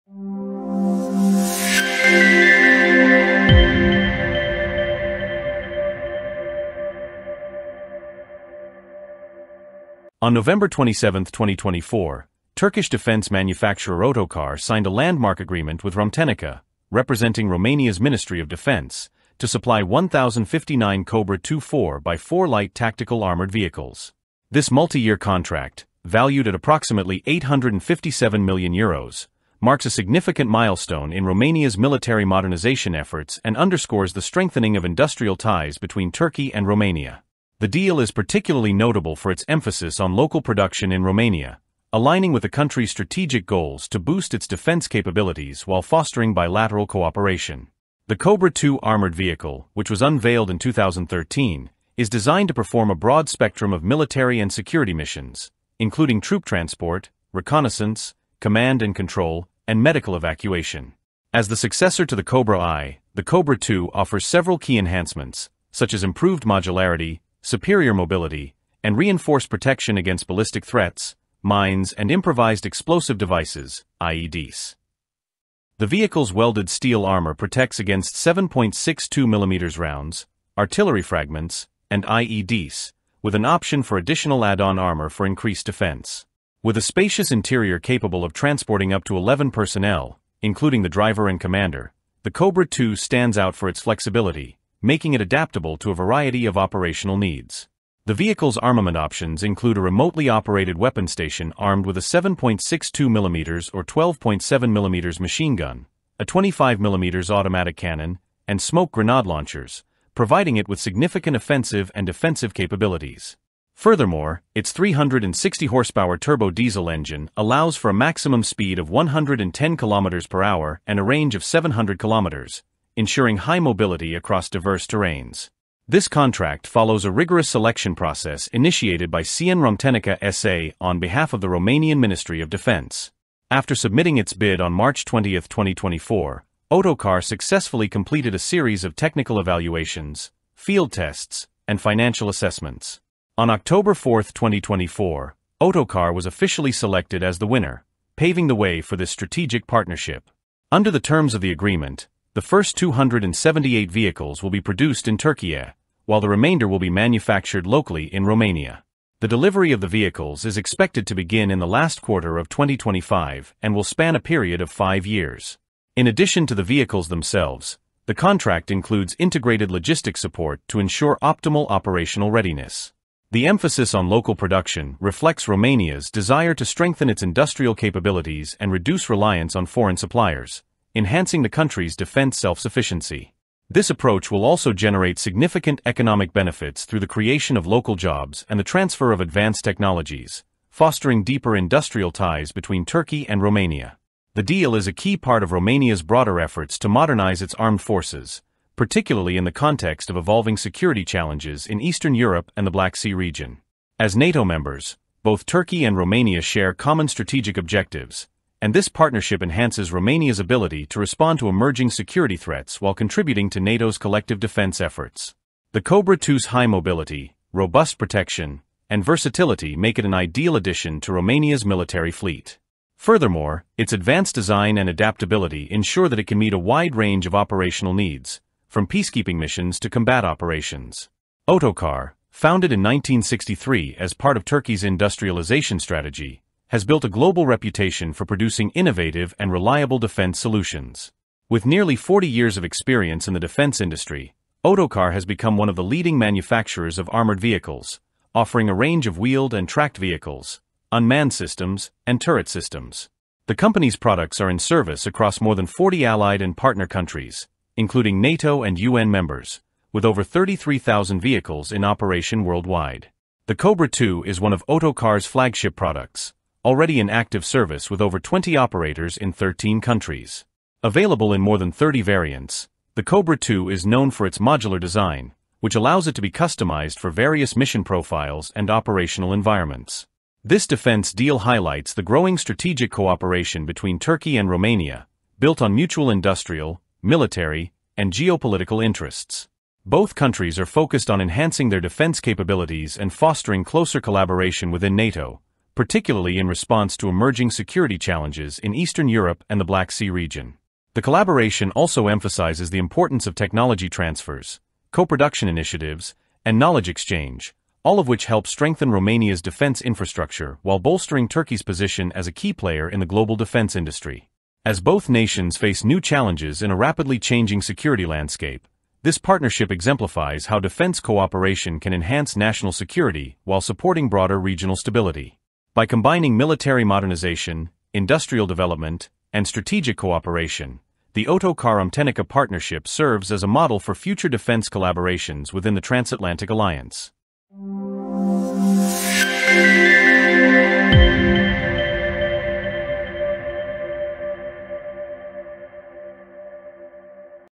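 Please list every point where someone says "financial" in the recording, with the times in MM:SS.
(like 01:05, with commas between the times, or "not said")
02:21.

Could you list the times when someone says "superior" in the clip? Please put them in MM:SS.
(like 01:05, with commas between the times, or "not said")
01:07.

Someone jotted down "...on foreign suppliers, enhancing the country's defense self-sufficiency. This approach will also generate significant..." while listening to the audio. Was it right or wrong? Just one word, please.
right.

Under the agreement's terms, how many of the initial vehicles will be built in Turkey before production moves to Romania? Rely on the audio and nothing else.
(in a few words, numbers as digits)
278.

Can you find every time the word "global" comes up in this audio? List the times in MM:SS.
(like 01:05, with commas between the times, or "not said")
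03:57, 05:13.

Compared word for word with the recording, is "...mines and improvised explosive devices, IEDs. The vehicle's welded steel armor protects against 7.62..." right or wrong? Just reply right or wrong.
right.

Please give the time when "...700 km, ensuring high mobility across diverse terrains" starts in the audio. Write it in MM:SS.
02:01.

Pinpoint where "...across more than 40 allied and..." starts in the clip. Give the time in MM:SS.
04:15.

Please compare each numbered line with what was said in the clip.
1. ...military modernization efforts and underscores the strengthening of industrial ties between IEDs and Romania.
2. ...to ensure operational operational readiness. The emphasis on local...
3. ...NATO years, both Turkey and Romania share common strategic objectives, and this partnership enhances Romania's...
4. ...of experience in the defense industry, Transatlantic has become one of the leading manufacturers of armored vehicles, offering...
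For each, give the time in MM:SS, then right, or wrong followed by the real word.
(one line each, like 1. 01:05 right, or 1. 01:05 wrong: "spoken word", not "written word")
1. 00:31 wrong: "Turkey", not "IEDs"
2. 02:50 wrong: "optimal", not "operational"
3. 03:24 wrong: "members", not "years"
4. 04:02 wrong: "Otokar", not "Transatlantic".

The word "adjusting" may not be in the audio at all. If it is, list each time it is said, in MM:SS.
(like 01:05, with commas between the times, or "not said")
not said.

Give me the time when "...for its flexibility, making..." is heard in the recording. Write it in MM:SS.
01:33.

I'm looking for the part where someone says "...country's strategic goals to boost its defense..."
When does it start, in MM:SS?
00:42.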